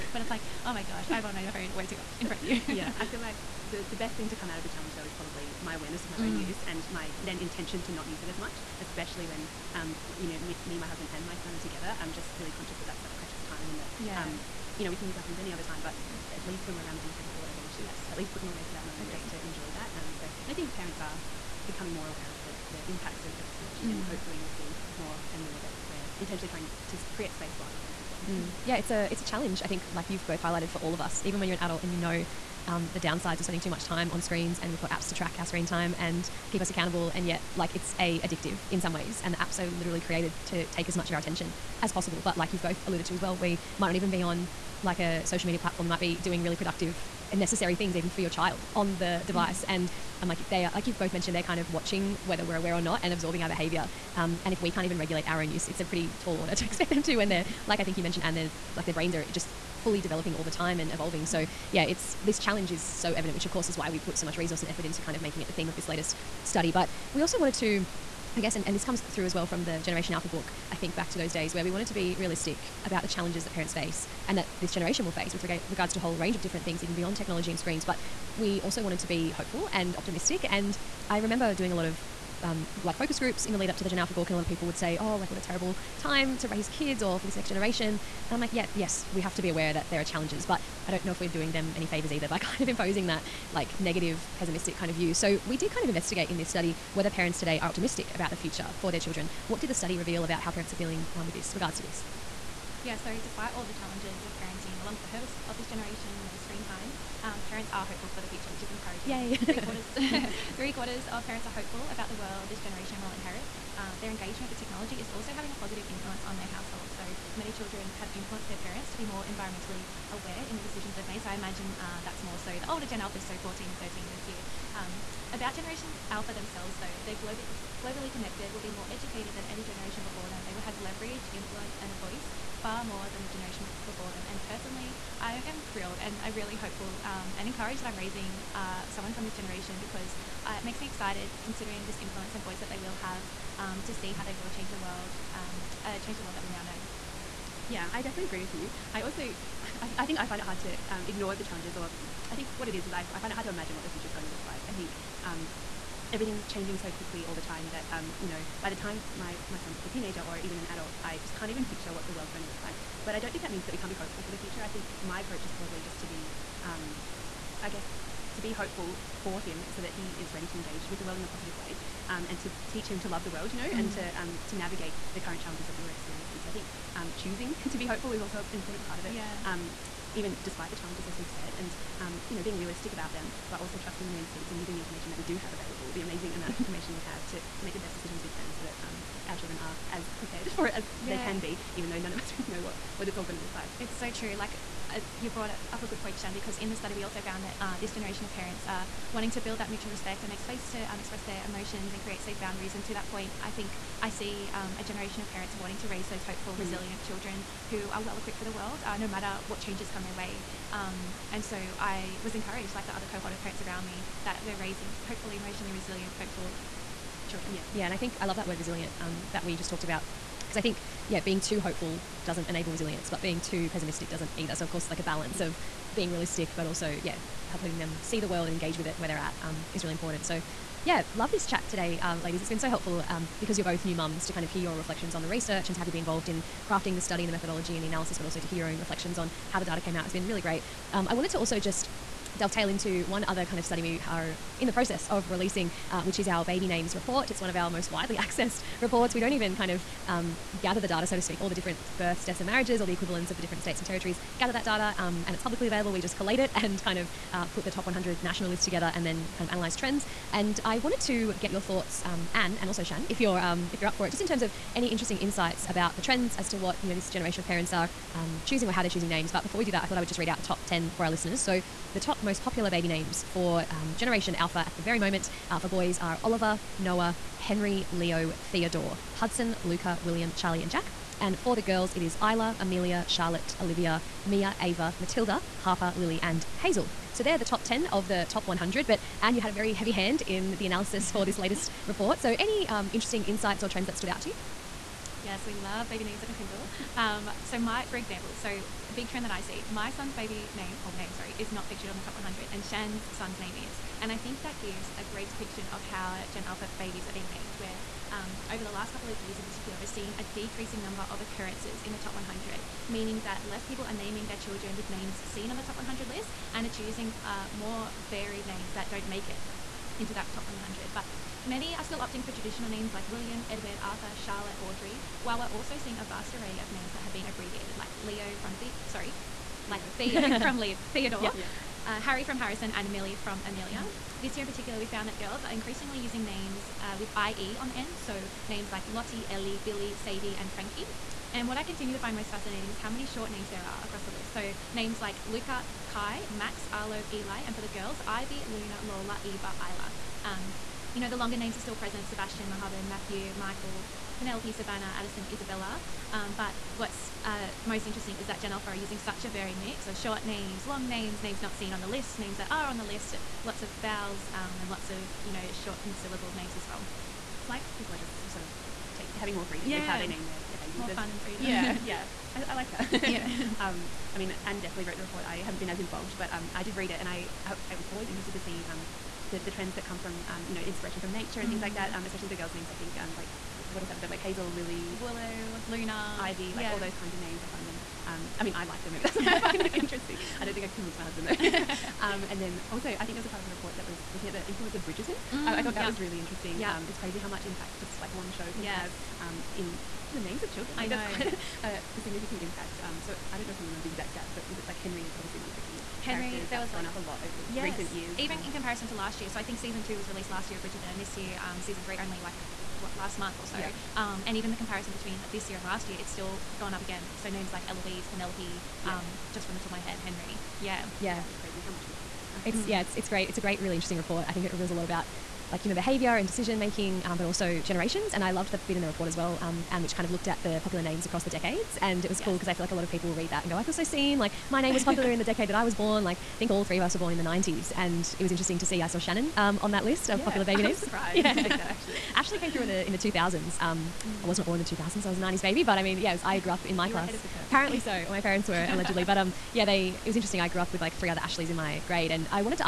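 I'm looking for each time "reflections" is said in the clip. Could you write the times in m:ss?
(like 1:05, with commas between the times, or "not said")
3:54, 3:58.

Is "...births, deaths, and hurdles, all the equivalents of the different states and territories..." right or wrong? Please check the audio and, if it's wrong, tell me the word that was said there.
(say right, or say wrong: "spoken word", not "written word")
wrong: "marriages", not "hurdles".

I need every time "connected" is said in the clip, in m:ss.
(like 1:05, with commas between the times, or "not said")
2:08.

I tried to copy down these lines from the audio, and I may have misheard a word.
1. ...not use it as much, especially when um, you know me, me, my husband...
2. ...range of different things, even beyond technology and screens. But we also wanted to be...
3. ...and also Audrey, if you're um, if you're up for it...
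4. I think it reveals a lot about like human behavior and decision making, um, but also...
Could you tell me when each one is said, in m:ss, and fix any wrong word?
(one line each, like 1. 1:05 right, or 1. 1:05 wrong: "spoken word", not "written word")
1. 0:07 right
2. 1:16 right
3. 4:22 wrong: "Shan", not "Audrey"
4. 7:04 right.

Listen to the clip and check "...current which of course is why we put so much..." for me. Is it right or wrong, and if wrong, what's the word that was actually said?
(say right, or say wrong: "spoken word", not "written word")
wrong: "evident", not "current".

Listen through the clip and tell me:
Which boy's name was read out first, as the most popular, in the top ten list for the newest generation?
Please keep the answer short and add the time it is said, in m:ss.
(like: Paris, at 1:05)
Oliver, at 4:36.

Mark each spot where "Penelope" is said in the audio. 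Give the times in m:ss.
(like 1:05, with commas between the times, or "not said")
5:54, 6:58.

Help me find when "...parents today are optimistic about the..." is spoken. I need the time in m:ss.
1:37.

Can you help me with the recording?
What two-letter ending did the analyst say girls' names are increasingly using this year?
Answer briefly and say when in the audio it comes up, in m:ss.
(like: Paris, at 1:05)
IE, at 5:37.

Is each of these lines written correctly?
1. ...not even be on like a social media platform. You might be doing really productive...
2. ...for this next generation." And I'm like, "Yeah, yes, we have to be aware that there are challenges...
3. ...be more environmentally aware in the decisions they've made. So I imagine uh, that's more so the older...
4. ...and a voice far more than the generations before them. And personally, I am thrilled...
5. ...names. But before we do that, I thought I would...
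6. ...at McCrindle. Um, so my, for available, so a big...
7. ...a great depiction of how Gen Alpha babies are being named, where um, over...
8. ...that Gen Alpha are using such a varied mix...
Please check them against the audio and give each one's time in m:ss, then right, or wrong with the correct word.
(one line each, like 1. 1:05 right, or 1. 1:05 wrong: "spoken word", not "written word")
1. 0:43 right
2. 1:27 right
3. 1:58 right
4. 2:11 right
5. 4:29 right
6. 4:56 wrong: "example", not "available"
7. 5:04 right
8. 5:58 right.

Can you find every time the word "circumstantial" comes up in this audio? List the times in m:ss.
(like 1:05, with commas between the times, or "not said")
not said.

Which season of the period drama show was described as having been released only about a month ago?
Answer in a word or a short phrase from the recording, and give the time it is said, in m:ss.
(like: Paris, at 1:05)
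season three, at 6:51.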